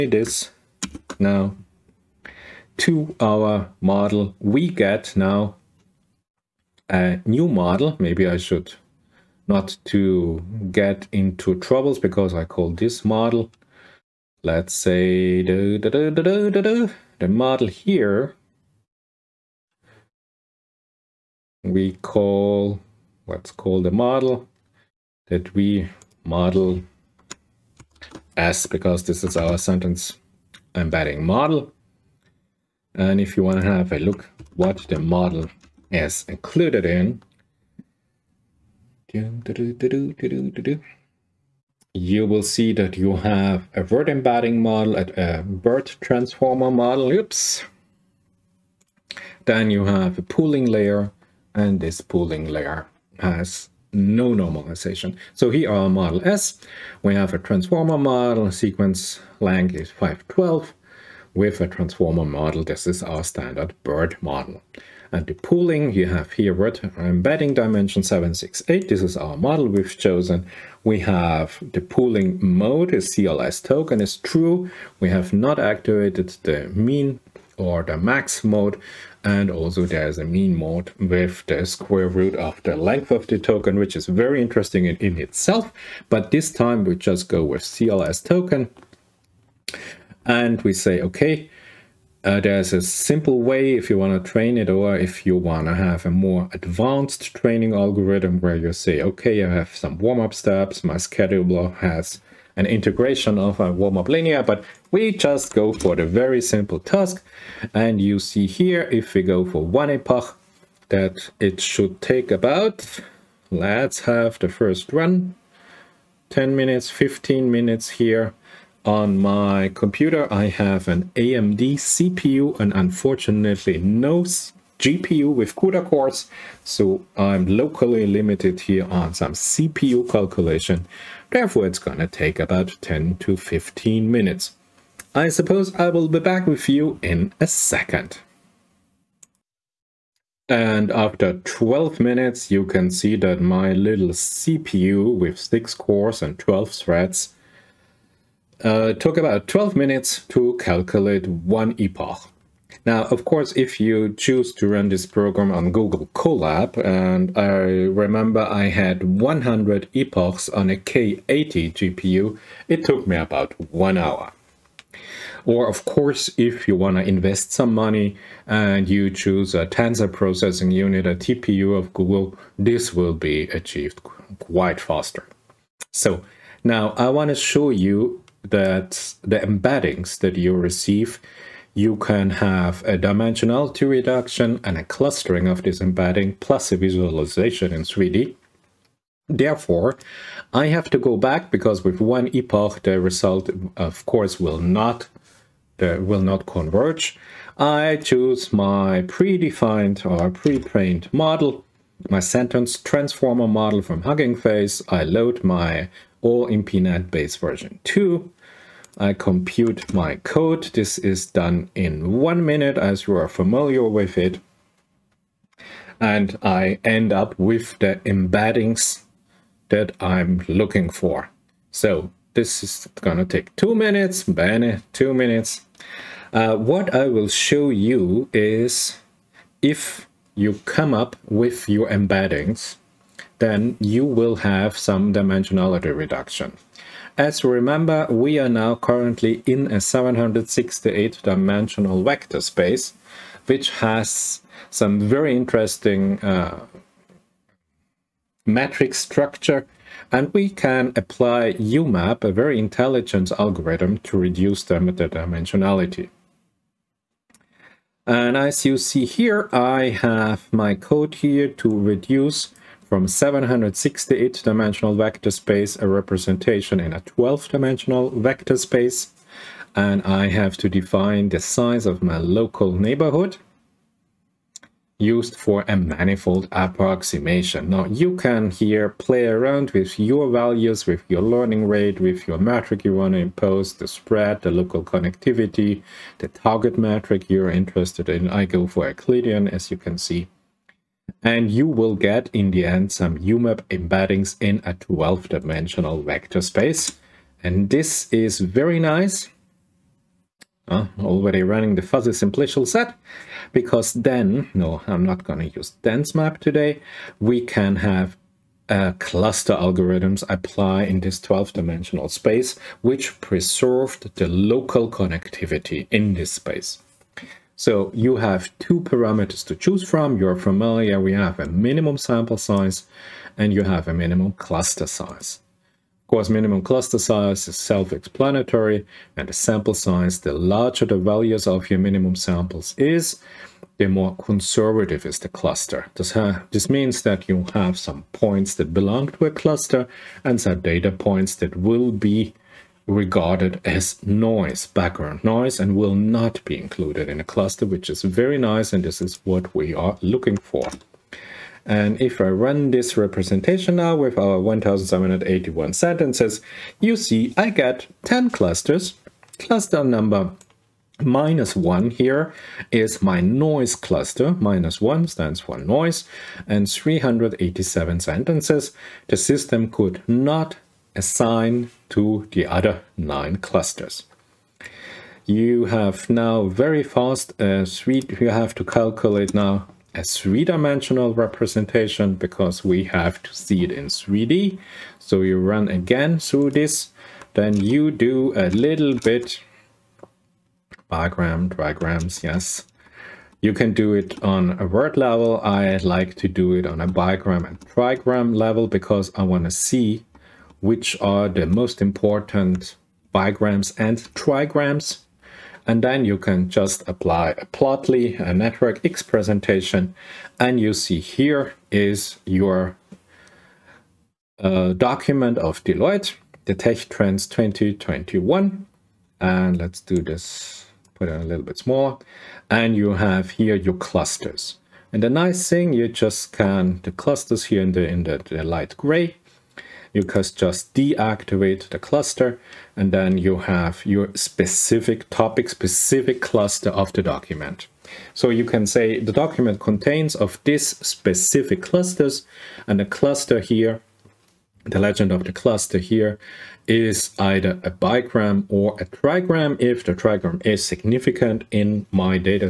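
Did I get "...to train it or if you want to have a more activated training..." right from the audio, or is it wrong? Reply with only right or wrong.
wrong.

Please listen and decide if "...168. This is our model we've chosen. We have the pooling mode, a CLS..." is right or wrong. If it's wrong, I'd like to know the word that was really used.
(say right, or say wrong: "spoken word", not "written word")
wrong: "768", not "168".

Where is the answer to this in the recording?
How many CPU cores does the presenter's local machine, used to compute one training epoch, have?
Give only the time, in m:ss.
2:25.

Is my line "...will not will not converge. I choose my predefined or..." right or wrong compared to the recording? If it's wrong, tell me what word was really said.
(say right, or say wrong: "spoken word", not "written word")
right.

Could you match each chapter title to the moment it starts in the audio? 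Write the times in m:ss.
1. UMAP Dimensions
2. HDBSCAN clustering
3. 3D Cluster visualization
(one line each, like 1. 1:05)
1. 3:48
2. 5:05
3. 6:48.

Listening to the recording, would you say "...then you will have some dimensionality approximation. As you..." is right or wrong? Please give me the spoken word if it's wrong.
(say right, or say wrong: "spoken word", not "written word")
wrong: "reduction", not "approximation".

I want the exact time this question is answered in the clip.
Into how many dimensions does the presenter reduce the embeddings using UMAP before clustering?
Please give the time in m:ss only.
4:26.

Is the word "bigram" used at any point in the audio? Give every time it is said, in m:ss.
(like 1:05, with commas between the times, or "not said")
6:36, 6:43, 7:27.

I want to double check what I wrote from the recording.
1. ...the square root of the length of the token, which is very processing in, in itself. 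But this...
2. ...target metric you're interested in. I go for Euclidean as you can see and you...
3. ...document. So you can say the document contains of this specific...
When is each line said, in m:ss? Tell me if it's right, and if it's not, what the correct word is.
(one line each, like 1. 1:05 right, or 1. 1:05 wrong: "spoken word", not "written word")
1. 1:21 wrong: "interesting", not "processing"
2. 4:46 right
3. 7:17 right.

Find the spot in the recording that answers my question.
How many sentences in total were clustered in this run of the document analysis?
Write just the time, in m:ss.
5:54.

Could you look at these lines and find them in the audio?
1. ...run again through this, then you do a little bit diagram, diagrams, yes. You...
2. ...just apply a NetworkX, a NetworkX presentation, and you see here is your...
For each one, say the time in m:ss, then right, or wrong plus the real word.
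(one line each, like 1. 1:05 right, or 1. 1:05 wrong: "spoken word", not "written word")
1. 6:25 right
2. 6:46 wrong: "Plotly", not "NetworkX".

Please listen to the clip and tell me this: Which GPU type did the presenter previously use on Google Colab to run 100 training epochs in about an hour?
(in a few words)
K80.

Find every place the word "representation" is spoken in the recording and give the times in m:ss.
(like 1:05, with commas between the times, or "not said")
4:25, 5:52, 6:21.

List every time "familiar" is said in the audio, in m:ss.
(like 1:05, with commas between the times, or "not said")
3:33, 5:20.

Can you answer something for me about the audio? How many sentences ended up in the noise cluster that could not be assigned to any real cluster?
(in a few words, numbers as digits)
387.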